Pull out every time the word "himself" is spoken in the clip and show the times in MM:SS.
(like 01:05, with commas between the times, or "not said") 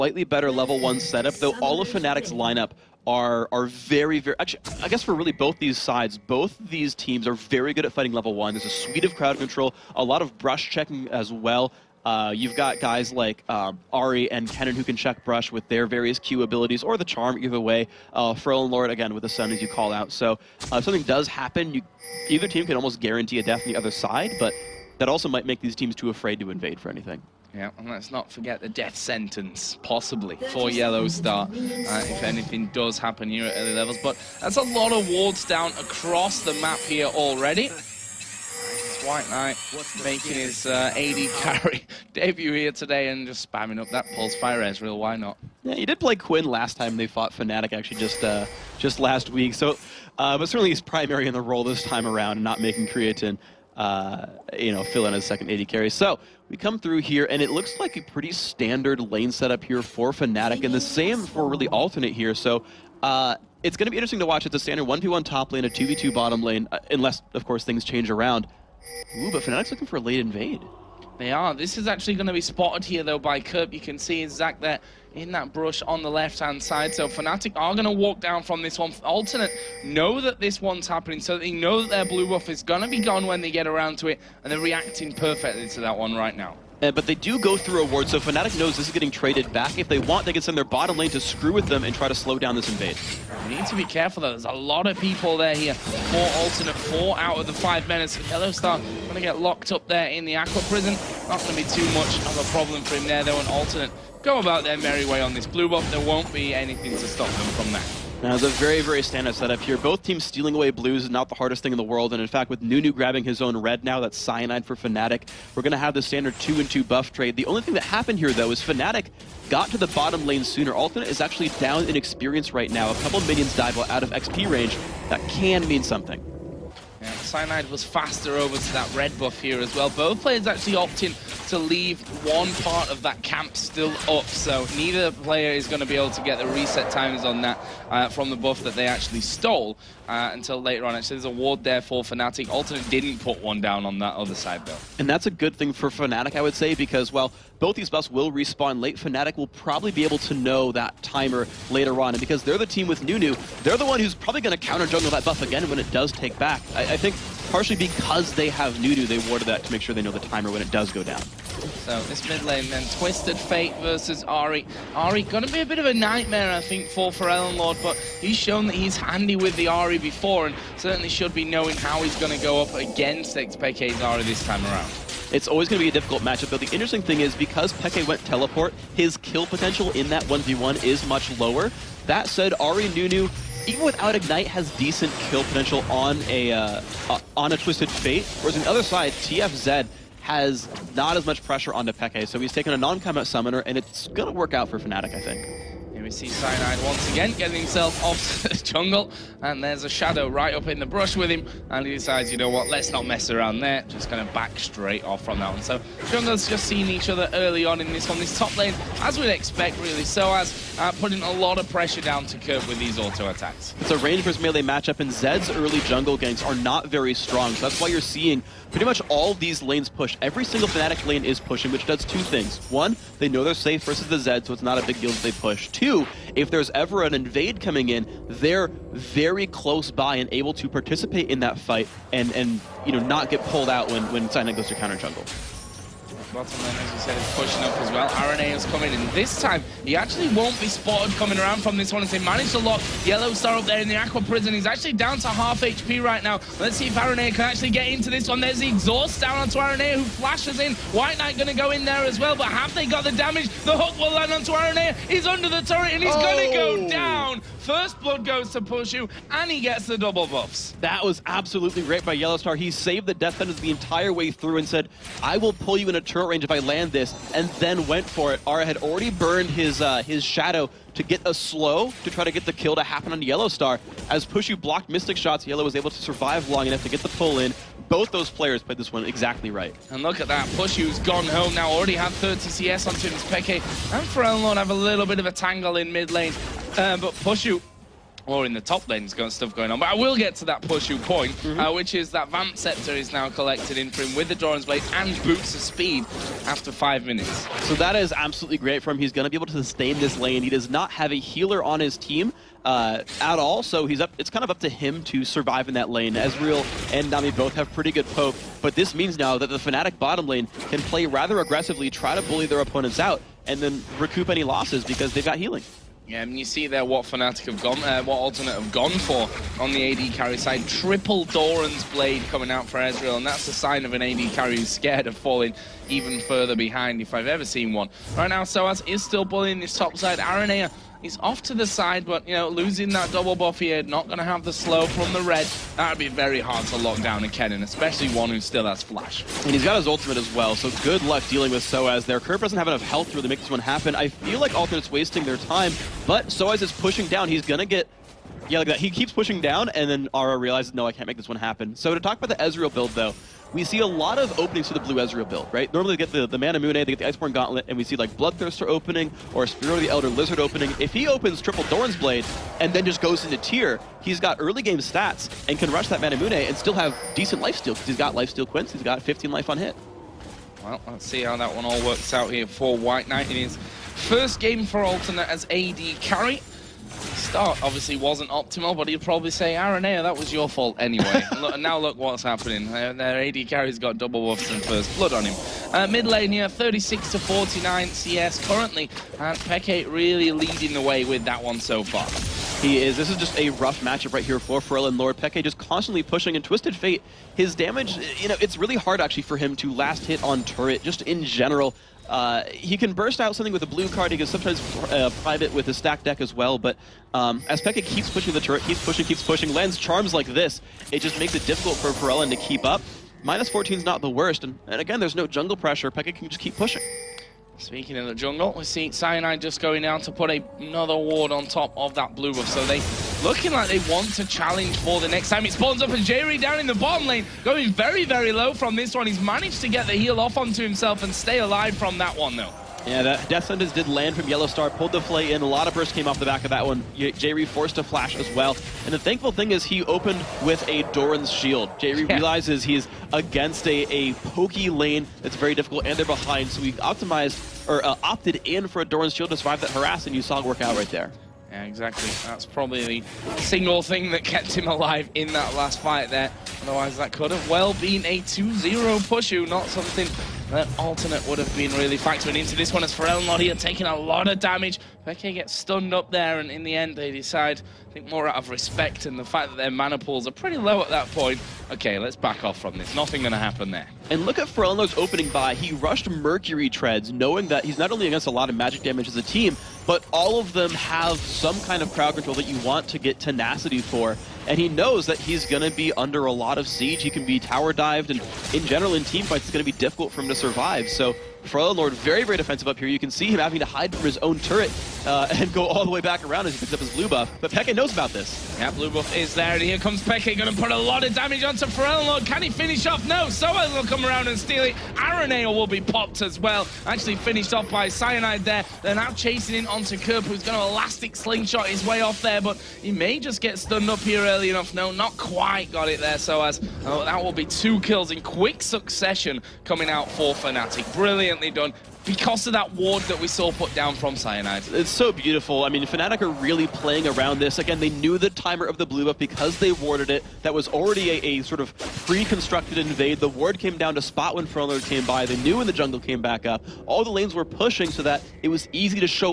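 03:17, 07:10.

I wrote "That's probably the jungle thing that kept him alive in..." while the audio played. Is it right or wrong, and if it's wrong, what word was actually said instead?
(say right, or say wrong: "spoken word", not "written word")
wrong: "single", not "jungle".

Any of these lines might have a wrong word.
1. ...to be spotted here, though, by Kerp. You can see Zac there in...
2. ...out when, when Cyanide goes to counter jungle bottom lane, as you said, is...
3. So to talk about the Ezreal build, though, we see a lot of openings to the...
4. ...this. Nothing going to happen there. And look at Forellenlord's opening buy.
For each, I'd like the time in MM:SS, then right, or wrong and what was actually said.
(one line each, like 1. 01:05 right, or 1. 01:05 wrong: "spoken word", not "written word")
1. 01:12 right
2. 03:53 right
3. 05:51 right
4. 07:52 right.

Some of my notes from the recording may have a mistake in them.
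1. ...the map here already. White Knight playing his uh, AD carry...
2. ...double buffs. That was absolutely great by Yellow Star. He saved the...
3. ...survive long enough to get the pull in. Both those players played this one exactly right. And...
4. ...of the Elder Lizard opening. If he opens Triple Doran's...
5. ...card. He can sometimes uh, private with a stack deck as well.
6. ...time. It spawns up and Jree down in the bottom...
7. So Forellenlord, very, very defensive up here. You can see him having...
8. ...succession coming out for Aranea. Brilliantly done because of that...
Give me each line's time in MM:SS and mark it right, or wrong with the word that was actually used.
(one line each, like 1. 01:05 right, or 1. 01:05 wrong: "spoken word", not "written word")
1. 00:36 wrong: "making", not "playing"
2. 04:19 right
3. 04:36 right
4. 05:59 right
5. 06:43 right
6. 07:05 right
7. 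08:10 right
8. 08:38 wrong: "Fnatic", not "Aranea".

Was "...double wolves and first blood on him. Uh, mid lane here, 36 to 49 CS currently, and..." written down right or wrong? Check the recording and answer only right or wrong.
right.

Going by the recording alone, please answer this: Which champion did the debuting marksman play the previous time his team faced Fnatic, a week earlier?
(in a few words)
Quinn.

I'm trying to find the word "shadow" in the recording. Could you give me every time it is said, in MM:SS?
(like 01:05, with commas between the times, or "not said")
03:19, 04:30.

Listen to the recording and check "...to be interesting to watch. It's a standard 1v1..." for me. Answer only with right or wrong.
right.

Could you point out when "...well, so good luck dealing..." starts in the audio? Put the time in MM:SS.
05:40.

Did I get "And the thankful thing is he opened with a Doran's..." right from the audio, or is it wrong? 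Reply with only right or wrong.
right.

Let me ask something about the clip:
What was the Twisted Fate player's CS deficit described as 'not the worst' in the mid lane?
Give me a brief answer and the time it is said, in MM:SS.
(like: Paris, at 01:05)
14, at 06:53.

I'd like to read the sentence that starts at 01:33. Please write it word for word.
We need to be careful, though.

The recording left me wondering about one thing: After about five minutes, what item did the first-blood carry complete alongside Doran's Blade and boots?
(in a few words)
Vamp Scepter.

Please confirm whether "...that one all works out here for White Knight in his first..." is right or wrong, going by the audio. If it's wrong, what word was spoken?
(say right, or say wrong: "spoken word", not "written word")
right.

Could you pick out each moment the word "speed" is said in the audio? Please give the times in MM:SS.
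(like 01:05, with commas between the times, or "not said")
04:55.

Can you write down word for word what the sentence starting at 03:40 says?
Every single Fnatic lane is pushing, which does two things.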